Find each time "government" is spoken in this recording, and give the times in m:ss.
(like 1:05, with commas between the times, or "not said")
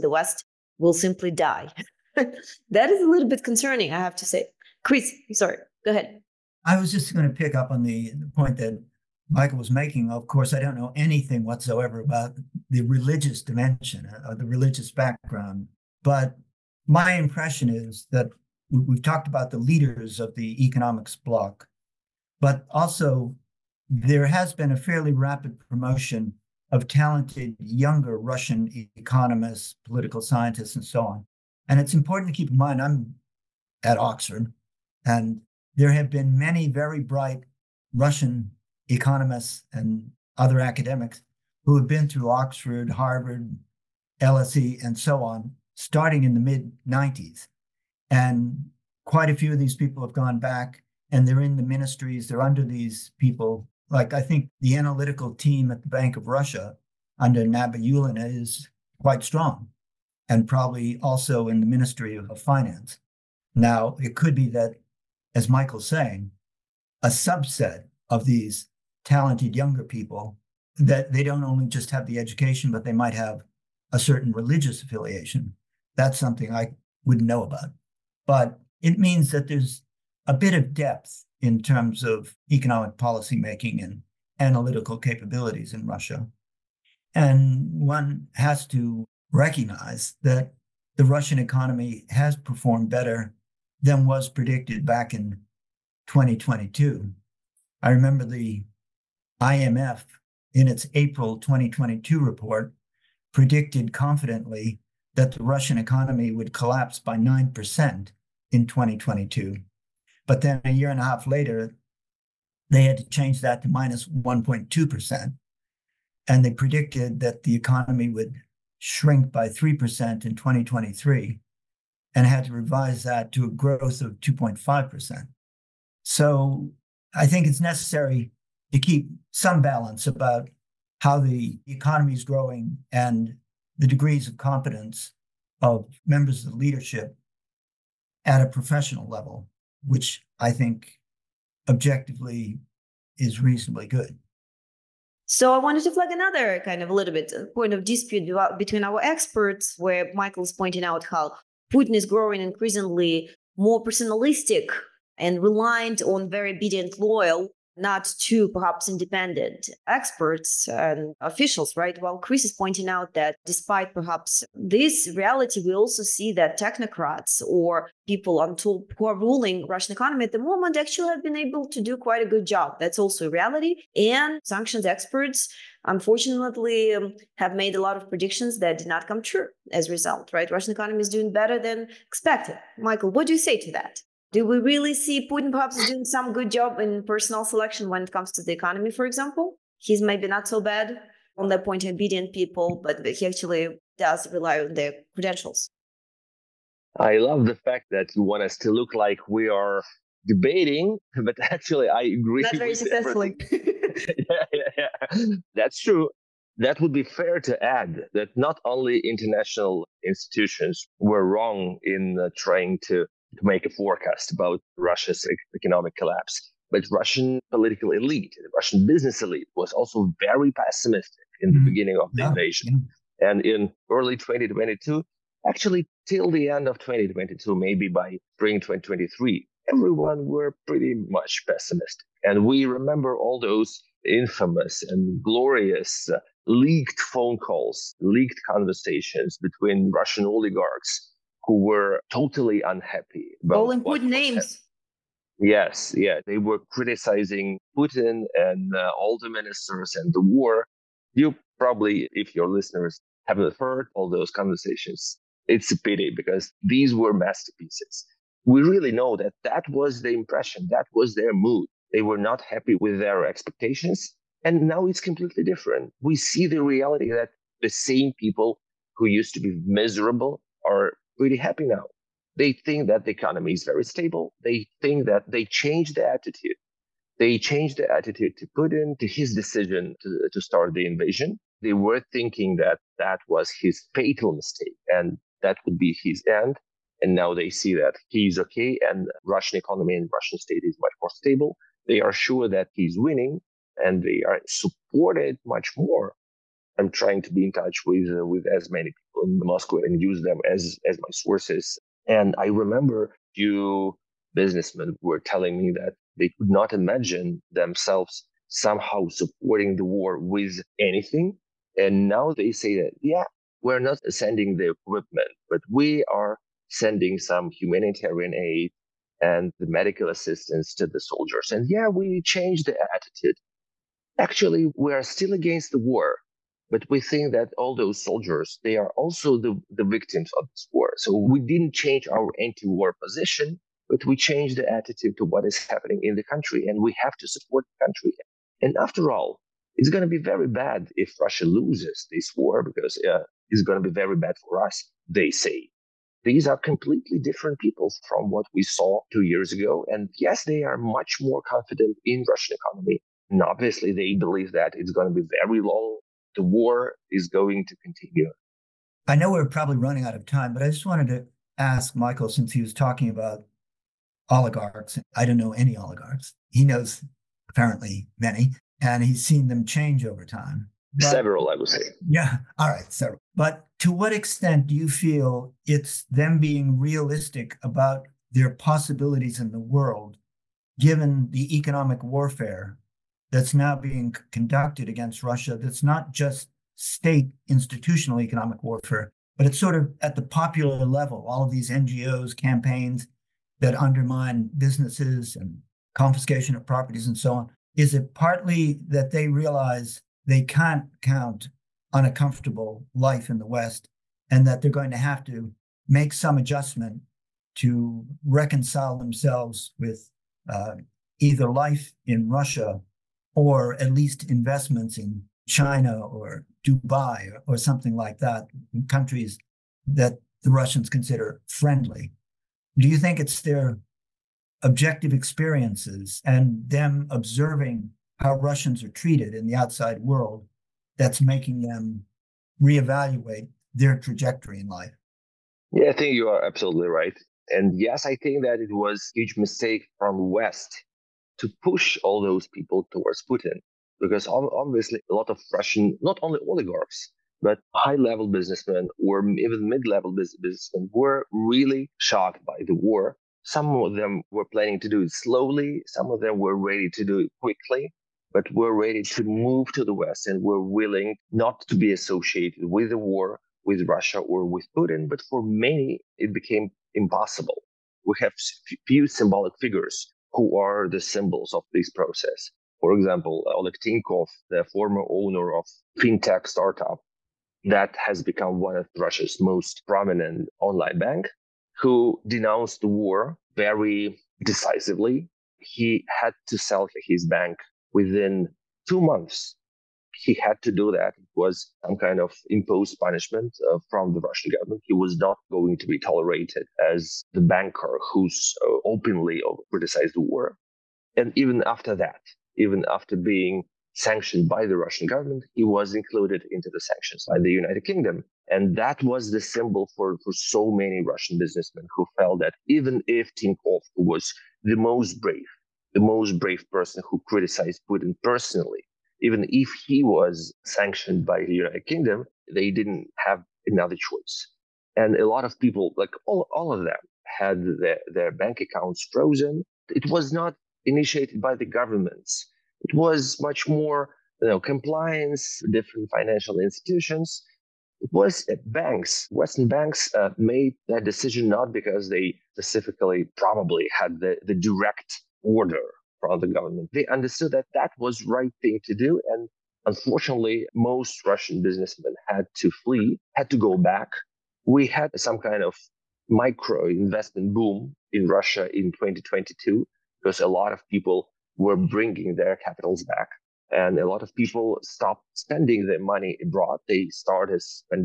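8:14, 8:25, 8:51, 9:06.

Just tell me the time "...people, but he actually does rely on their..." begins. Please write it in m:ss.
3:12.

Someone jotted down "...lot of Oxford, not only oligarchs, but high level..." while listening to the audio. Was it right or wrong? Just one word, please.
wrong.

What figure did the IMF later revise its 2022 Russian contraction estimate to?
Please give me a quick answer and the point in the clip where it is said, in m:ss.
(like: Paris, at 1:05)
-1.2%, at 1:53.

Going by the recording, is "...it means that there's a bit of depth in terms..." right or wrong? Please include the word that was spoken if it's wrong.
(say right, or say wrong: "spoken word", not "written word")
right.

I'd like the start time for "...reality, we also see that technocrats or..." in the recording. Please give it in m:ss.
2:45.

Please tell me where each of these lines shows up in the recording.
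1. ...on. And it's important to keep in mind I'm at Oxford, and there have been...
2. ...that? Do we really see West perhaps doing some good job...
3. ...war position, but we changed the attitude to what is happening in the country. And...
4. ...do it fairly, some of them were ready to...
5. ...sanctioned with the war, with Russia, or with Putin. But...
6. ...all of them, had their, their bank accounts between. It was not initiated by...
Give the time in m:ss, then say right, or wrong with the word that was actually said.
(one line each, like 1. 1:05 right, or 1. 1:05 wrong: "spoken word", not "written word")
1. 0:31 right
2. 3:03 wrong: "Putin", not "West"
3. 5:32 right
4. 7:34 wrong: "slowly", not "fairly"
5. 7:41 wrong: "associated", not "sanctioned"
6. 8:46 wrong: "frozen", not "between".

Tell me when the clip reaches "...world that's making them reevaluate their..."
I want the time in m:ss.
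7:09.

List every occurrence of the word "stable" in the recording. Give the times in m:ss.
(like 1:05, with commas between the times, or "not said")
4:33, 4:51.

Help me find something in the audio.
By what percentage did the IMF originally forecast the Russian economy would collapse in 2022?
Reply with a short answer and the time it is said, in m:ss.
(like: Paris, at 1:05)
9%, at 1:47.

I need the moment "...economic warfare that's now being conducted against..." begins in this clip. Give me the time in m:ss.
6:21.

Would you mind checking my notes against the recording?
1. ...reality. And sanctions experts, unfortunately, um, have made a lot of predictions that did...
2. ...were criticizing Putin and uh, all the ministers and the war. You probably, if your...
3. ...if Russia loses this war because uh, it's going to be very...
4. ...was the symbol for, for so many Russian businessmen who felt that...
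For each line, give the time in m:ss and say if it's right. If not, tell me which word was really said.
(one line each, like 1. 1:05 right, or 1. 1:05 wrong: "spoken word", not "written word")
1. 2:53 right
2. 4:06 right
3. 5:40 right
4. 8:29 right.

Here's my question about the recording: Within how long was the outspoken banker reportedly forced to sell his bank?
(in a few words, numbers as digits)
two months.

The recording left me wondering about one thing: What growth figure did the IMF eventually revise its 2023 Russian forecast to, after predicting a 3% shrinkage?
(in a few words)
2.5%.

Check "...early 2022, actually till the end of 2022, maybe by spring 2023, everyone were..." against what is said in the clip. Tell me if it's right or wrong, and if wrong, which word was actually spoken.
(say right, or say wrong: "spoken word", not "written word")
right.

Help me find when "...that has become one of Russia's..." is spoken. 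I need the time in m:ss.
7:57.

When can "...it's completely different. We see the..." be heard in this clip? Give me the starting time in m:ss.
4:24.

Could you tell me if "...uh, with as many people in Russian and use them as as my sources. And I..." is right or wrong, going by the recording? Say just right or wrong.
wrong.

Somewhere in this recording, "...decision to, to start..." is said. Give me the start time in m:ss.
4:39.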